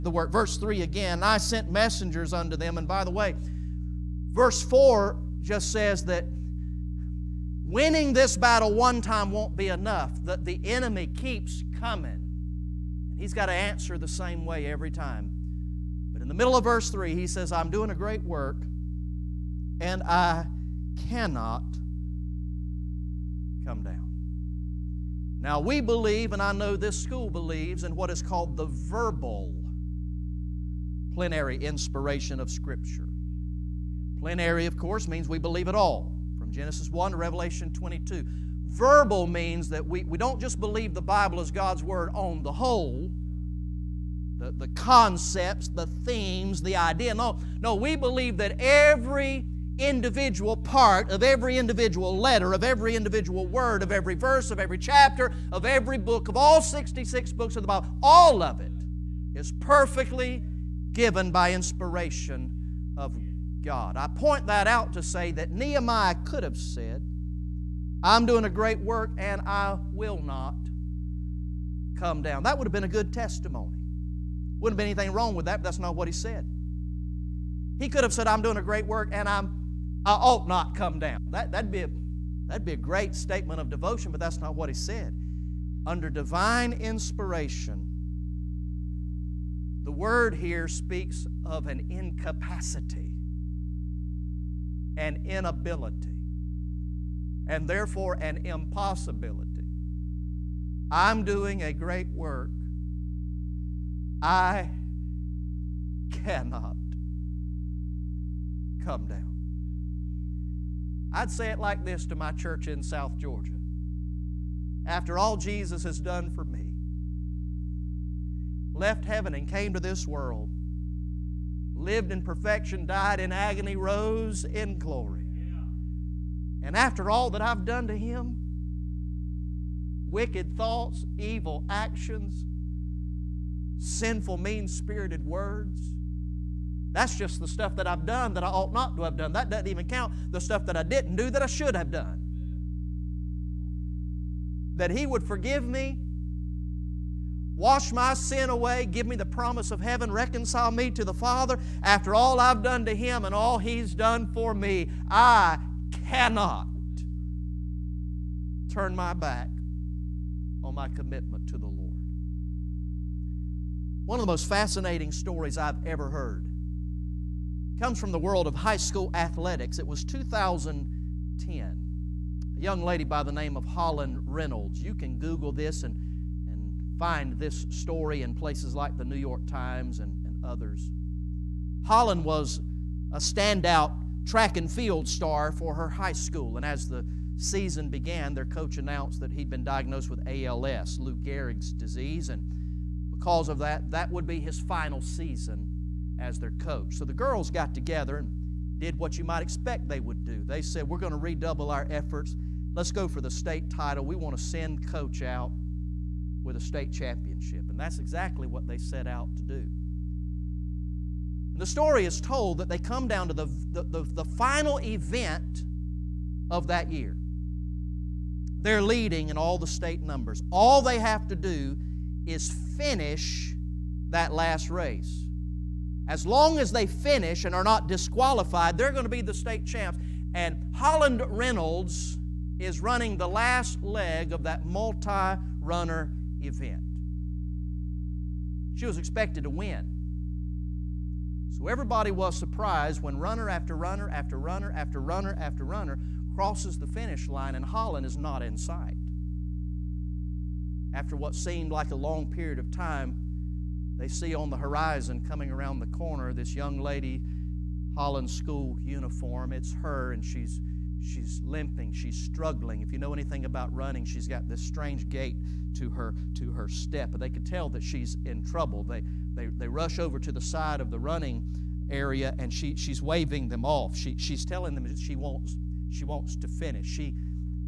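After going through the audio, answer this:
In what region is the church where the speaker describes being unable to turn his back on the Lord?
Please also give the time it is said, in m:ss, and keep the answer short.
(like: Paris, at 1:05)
South Georgia, at 1:52.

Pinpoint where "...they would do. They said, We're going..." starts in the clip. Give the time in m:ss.
3:19.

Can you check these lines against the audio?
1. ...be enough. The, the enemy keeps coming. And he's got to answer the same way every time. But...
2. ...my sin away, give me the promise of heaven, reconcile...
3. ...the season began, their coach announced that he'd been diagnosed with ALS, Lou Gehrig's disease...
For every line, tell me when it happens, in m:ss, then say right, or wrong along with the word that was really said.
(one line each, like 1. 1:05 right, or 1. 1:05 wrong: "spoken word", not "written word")
1. 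0:09 right
2. 2:27 right
3. 3:06 right.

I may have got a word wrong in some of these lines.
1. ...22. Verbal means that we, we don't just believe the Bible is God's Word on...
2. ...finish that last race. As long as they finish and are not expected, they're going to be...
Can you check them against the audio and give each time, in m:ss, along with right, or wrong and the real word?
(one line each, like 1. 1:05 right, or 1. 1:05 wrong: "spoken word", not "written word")
1. 0:37 right
2. 3:42 wrong: "disqualified", not "expected".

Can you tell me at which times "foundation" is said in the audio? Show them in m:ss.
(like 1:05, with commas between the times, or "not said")
not said.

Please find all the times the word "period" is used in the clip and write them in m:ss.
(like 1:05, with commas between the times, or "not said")
4:12.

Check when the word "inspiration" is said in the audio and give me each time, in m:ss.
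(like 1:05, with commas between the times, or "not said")
0:31, 1:01, 1:26.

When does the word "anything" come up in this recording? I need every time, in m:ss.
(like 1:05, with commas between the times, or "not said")
1:14, 4:23.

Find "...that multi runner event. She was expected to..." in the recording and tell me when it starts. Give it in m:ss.
3:54.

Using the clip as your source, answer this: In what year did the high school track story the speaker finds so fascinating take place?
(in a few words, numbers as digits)
2010.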